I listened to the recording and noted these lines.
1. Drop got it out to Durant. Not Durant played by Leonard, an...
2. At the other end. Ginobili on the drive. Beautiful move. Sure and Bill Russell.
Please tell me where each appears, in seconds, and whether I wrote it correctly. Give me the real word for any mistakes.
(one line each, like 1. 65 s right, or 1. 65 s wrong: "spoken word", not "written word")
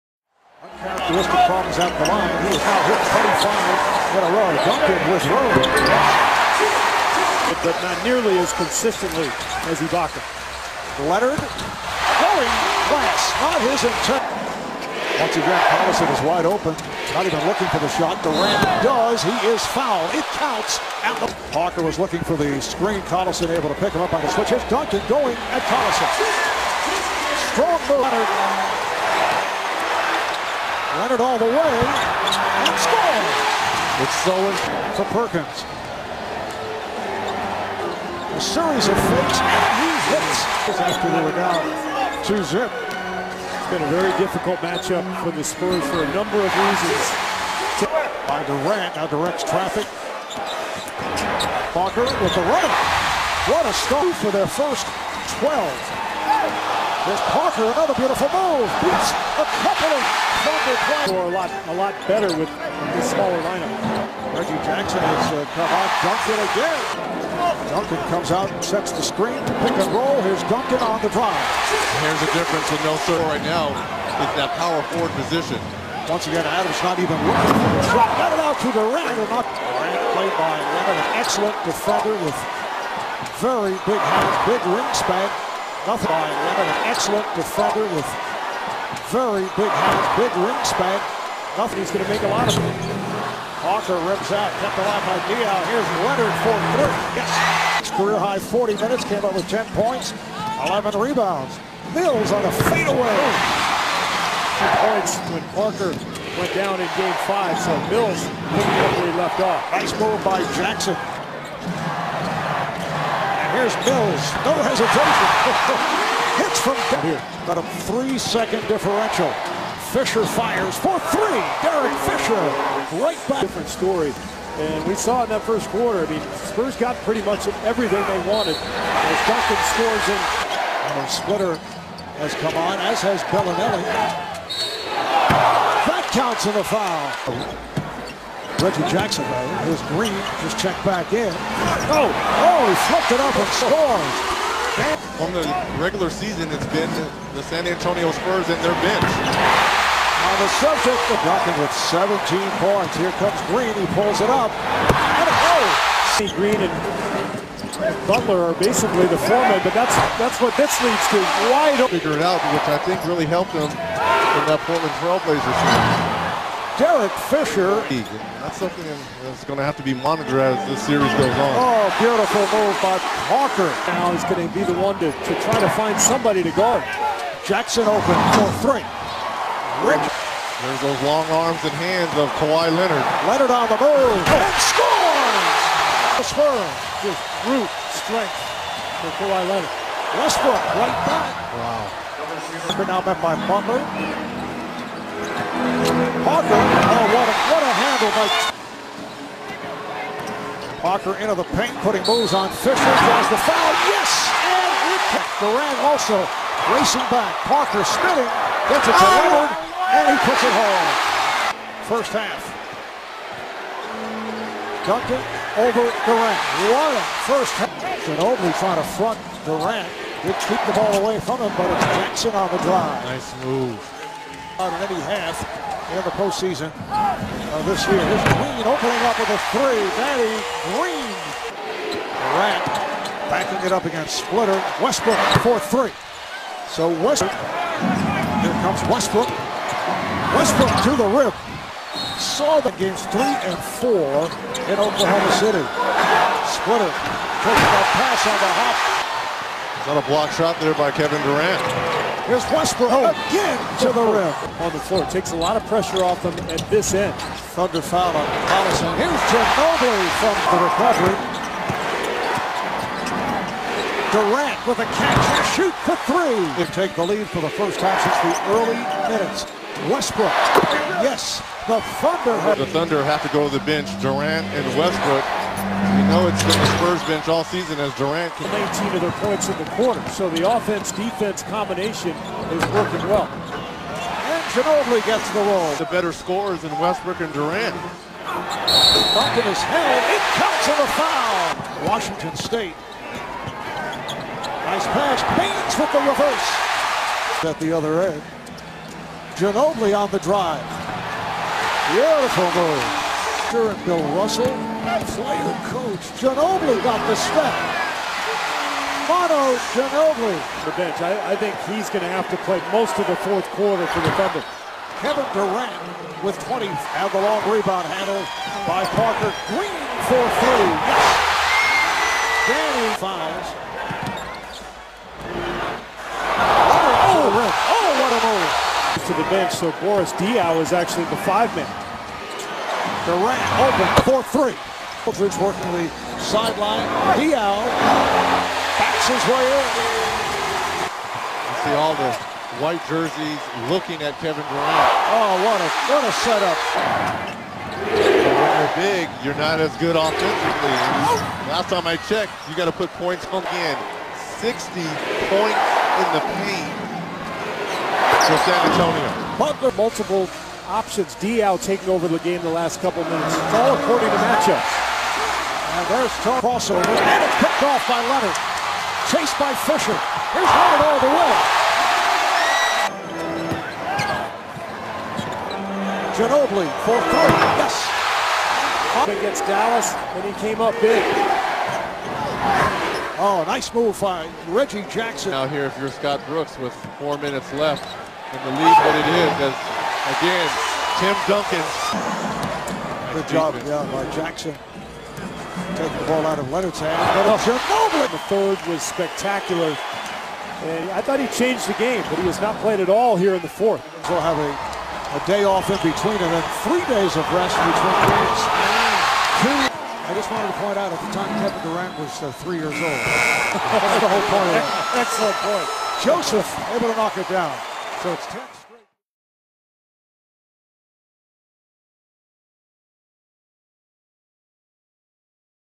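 1. 77 s right
2. 297 s right.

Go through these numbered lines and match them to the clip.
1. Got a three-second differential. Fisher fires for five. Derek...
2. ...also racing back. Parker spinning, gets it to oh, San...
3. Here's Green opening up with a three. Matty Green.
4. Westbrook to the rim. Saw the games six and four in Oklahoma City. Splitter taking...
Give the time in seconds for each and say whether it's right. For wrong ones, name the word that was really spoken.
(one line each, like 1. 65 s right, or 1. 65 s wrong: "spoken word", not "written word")
1. 117 s wrong: "three", not "five"
2. 205 s wrong: "Leonard", not "San"
3. 227 s right
4. 240 s wrong: "three", not "six".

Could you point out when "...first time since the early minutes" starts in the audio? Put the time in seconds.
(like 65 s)
267 s.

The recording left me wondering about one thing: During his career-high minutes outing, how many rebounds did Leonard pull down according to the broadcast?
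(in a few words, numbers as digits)
11.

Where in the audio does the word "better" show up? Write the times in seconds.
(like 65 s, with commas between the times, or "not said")
62 s, 285 s.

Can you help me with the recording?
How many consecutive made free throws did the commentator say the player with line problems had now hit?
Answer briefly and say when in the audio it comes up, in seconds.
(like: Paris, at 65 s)
25, at 4 s.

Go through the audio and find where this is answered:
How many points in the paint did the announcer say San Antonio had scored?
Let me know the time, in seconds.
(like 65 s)
354 s.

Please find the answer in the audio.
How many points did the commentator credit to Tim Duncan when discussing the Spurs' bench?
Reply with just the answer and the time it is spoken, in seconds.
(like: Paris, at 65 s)
17, at 151 s.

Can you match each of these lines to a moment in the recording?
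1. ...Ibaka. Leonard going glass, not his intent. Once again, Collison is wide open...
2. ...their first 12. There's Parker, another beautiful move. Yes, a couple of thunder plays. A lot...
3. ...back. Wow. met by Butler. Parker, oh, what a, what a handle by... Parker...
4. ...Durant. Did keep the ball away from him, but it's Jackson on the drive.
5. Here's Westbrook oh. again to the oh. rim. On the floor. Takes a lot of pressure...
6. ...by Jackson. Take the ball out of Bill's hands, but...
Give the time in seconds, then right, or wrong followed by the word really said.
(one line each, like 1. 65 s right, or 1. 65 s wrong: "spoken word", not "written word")
1. 9 s right
2. 54 s right
3. 191 s right
4. 219 s right
5. 252 s right
6. 393 s wrong: "Leonard", not "Bill".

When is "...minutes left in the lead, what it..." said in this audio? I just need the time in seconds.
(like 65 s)
387 s.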